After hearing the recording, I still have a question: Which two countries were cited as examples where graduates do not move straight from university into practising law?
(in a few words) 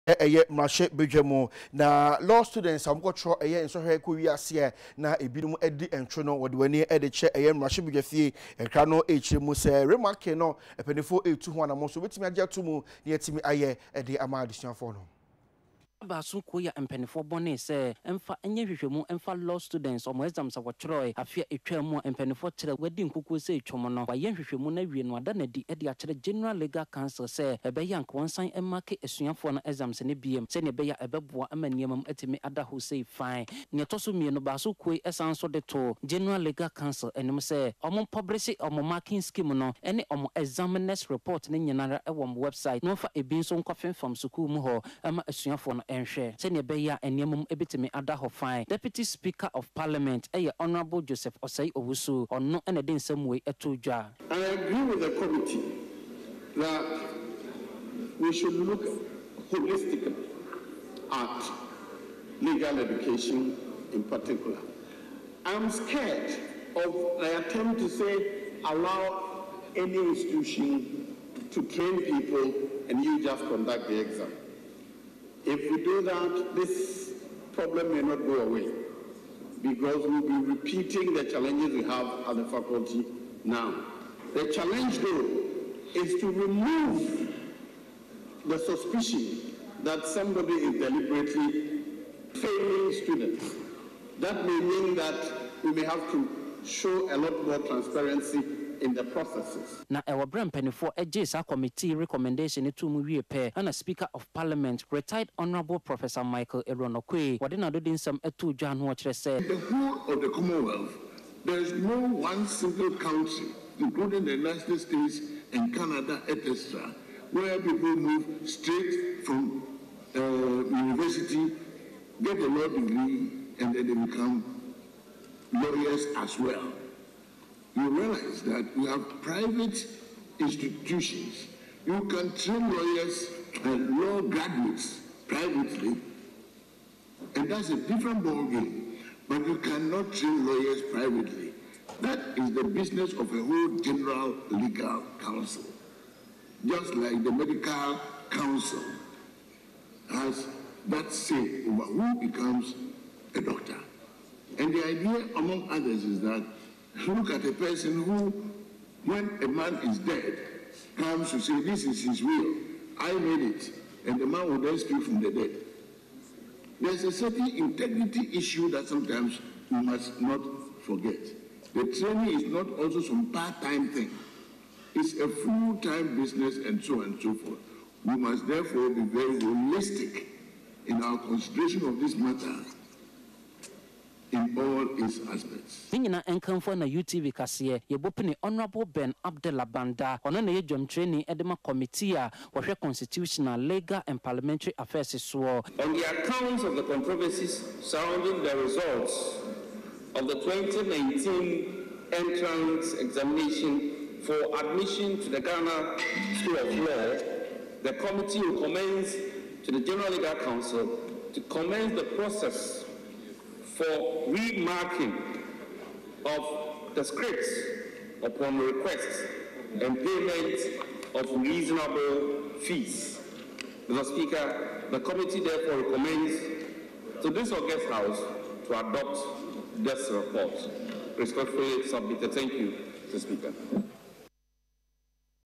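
United States and Canada.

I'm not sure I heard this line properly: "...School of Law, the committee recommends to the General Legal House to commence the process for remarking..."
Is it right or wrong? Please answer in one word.
wrong.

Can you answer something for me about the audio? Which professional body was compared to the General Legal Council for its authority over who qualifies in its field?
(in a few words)
medical council.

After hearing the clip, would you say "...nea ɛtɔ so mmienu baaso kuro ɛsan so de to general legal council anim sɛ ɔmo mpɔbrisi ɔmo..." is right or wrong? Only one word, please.
right.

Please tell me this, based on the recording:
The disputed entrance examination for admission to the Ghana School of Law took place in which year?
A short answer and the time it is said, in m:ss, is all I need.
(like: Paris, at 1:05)
2019, at 3:20.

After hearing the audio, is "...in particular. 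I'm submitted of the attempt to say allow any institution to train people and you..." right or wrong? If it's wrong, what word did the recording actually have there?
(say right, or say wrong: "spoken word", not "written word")
wrong: "scared", not "submitted".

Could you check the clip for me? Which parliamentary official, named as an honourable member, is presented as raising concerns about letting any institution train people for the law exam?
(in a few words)
Joseph Osei-Owusu.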